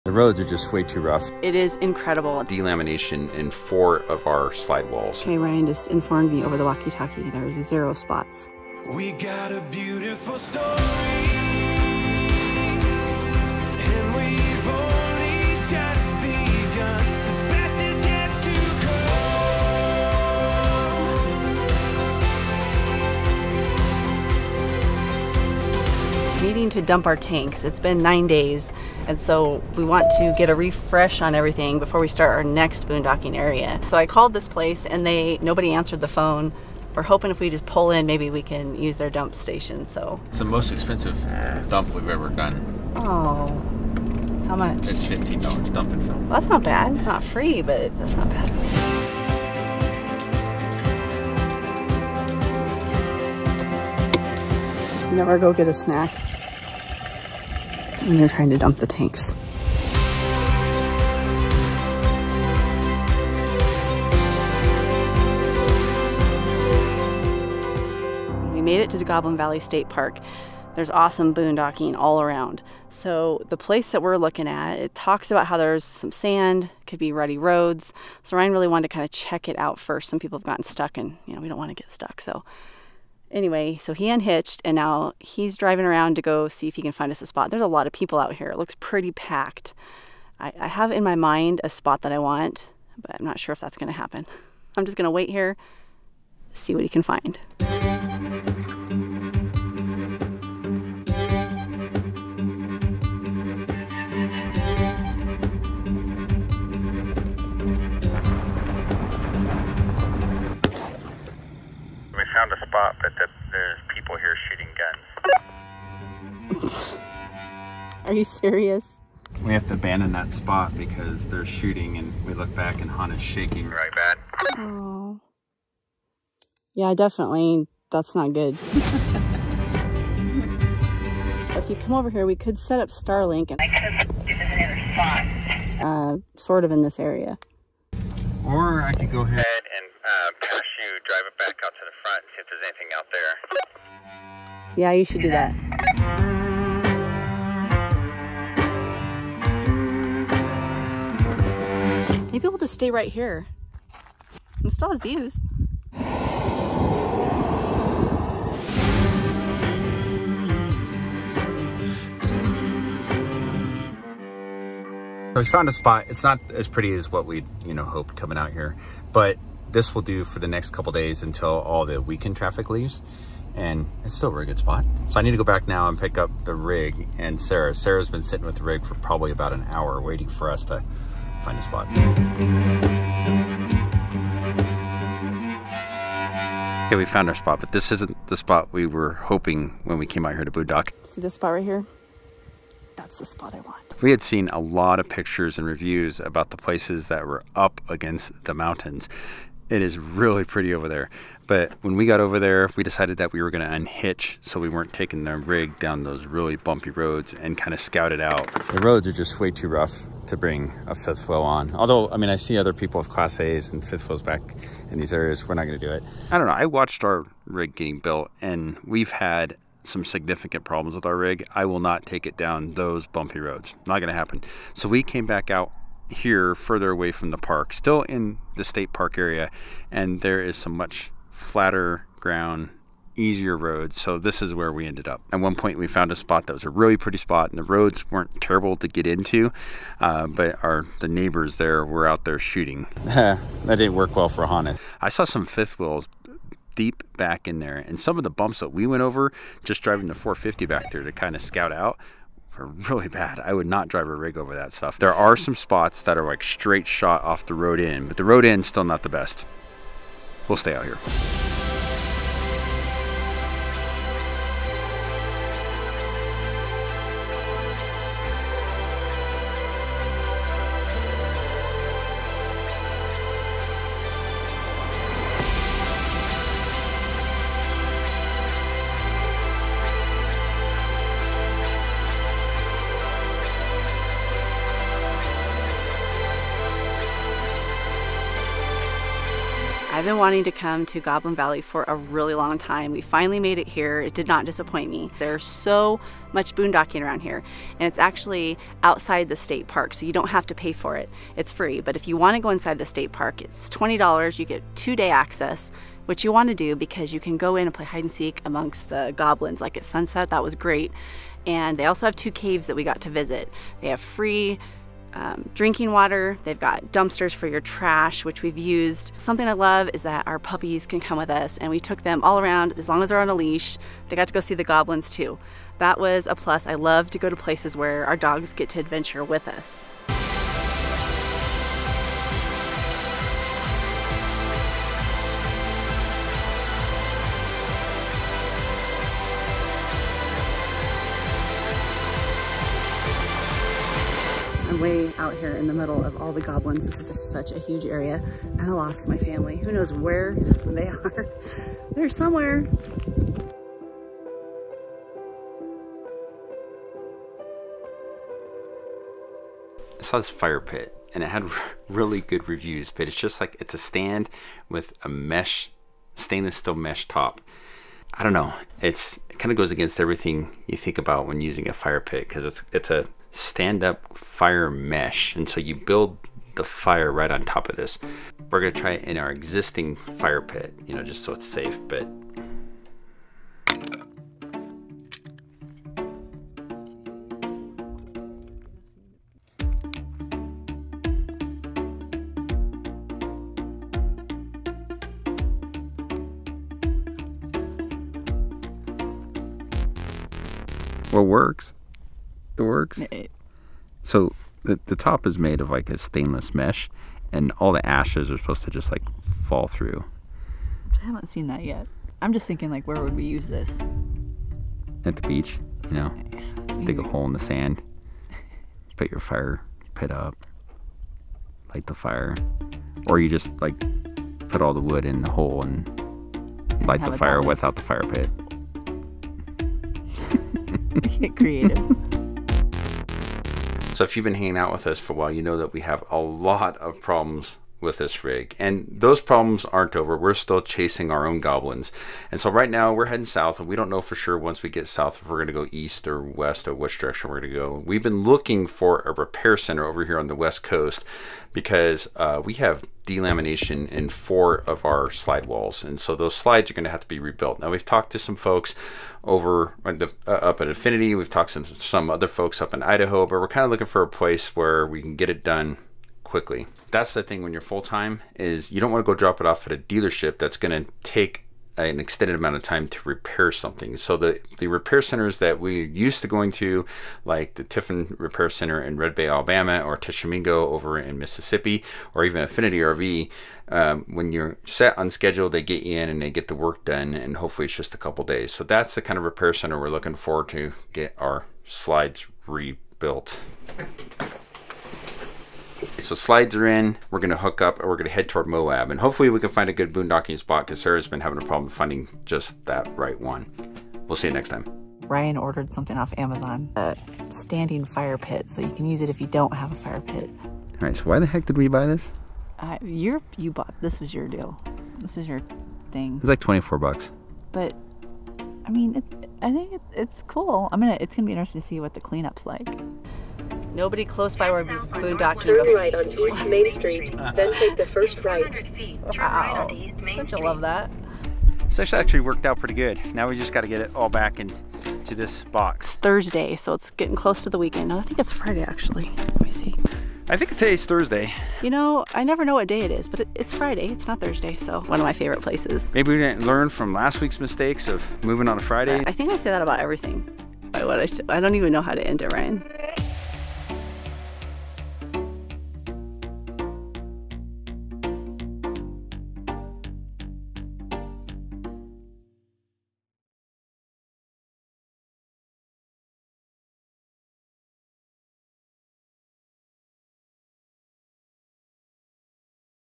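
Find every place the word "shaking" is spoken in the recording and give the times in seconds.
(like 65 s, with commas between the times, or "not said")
123 s.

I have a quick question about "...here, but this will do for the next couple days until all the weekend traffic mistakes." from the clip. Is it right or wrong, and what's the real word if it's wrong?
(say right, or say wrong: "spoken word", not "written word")
wrong: "leaves", not "mistakes".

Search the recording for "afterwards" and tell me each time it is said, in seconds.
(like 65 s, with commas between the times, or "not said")
402 s.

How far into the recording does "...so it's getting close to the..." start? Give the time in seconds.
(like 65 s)
536 s.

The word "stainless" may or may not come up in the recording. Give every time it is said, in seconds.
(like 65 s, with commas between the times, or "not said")
366 s, 405 s.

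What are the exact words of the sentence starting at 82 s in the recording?
So Anyway, so he unhitched and now he's driving around to go see if he can find us a spot.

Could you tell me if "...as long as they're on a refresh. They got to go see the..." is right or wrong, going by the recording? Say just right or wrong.
wrong.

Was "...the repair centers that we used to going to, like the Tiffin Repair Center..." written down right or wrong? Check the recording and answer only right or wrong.
right.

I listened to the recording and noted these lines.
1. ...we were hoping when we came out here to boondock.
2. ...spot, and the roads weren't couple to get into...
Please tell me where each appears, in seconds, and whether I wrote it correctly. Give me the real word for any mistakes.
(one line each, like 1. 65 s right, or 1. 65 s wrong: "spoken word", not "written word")
1. 188 s right
2. 237 s wrong: "terrible", not "couple".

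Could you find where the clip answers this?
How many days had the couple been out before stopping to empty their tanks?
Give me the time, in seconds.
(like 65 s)
28 s.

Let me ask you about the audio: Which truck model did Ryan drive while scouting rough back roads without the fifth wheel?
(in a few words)
450.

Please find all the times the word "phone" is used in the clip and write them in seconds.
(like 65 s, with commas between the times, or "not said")
36 s.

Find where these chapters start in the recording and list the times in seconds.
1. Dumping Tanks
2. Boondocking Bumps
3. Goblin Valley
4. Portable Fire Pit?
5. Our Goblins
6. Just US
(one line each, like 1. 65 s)
1. 26 s
2. 67 s
3. 261 s
4. 360 s
5. 434 s
6. 505 s.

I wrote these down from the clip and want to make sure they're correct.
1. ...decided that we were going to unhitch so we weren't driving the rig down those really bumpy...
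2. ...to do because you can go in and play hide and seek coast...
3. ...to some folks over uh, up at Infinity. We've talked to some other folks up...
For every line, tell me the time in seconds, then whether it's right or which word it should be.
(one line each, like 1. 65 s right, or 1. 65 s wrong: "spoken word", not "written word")
1. 202 s wrong: "taking", not "driving"
2. 306 s wrong: "amongst", not "coast"
3. 458 s right.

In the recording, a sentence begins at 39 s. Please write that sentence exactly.
So it's the most expensive dump we've ever done.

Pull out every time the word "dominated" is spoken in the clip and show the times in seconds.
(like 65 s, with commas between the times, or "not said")
not said.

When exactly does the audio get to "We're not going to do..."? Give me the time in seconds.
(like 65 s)
215 s.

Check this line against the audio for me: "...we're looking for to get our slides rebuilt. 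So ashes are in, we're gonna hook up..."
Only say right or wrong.
wrong.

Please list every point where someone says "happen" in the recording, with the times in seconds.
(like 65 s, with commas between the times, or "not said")
93 s, 224 s.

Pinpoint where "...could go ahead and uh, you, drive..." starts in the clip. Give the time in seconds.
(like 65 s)
138 s.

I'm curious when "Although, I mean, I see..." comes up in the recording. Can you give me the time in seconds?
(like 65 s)
211 s.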